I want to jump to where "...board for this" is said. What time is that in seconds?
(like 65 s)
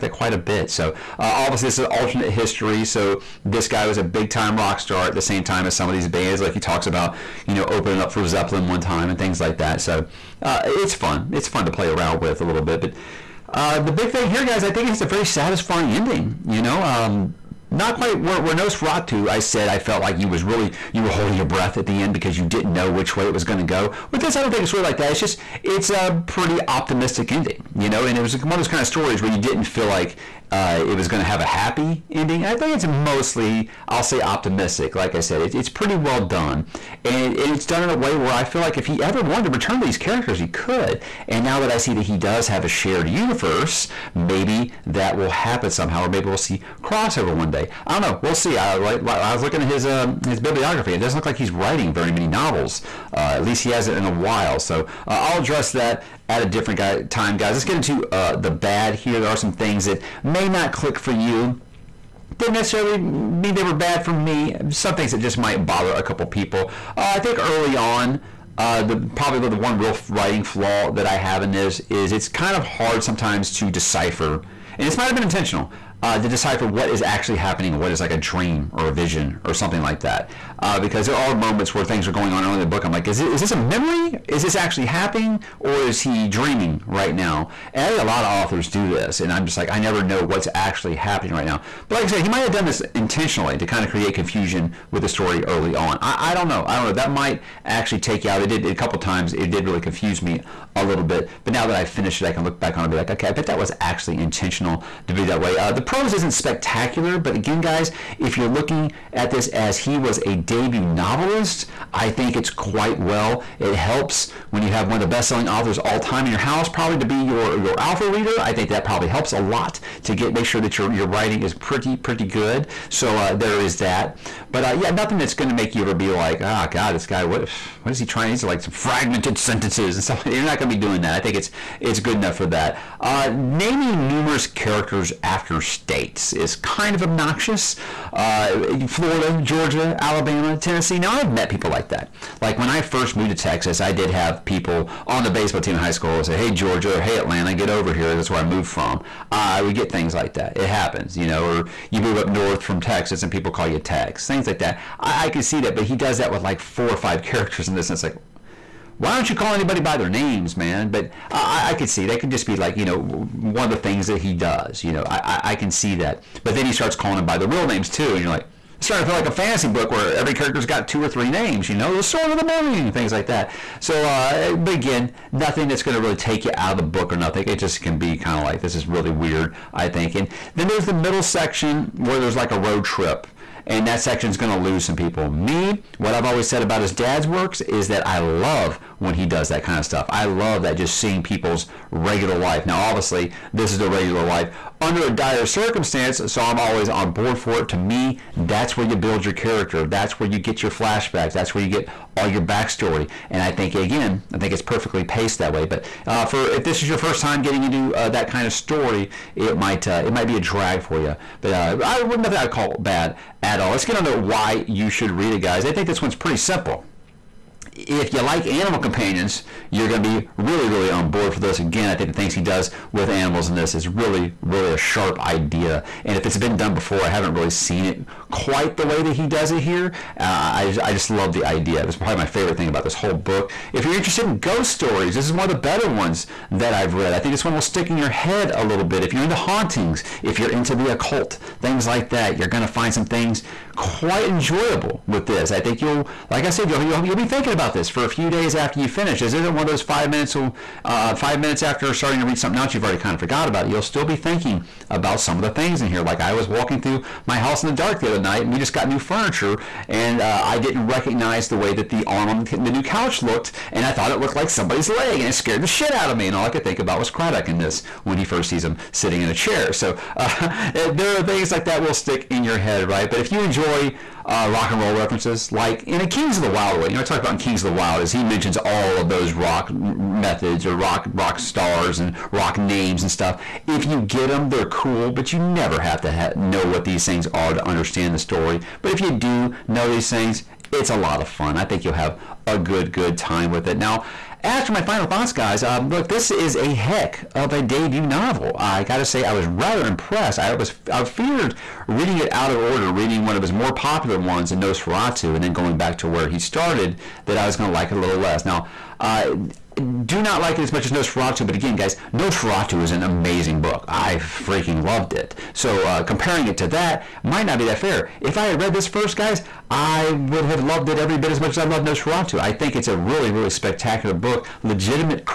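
221 s.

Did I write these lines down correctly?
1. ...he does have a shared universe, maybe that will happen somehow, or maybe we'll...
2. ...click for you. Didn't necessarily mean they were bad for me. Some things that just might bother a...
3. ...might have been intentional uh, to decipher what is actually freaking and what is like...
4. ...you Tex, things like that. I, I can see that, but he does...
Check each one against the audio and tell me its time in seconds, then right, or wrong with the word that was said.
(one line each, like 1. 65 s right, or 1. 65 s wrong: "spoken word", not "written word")
1. 42 s right
2. 60 s right
3. 74 s wrong: "happening", not "freaking"
4. 153 s right.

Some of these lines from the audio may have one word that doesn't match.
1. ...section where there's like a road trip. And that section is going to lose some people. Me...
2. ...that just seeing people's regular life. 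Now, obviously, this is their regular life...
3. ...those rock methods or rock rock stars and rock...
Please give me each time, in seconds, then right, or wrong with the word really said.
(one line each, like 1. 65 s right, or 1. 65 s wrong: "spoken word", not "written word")
1. 181 s right
2. 190 s right
3. 279 s right.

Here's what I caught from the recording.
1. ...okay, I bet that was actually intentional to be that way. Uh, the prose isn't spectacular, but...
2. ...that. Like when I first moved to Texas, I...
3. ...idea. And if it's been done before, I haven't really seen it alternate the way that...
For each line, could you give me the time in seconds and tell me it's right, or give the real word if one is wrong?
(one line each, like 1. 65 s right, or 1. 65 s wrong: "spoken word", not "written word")
1. 103 s right
2. 141 s right
3. 225 s wrong: "quite", not "alternate".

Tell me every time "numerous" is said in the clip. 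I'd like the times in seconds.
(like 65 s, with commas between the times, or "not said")
134 s.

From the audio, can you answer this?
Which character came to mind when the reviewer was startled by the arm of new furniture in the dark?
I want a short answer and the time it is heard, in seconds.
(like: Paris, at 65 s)
Craddock, at 267 s.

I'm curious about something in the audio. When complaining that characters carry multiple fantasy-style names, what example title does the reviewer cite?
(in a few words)
the Sword of the Morning.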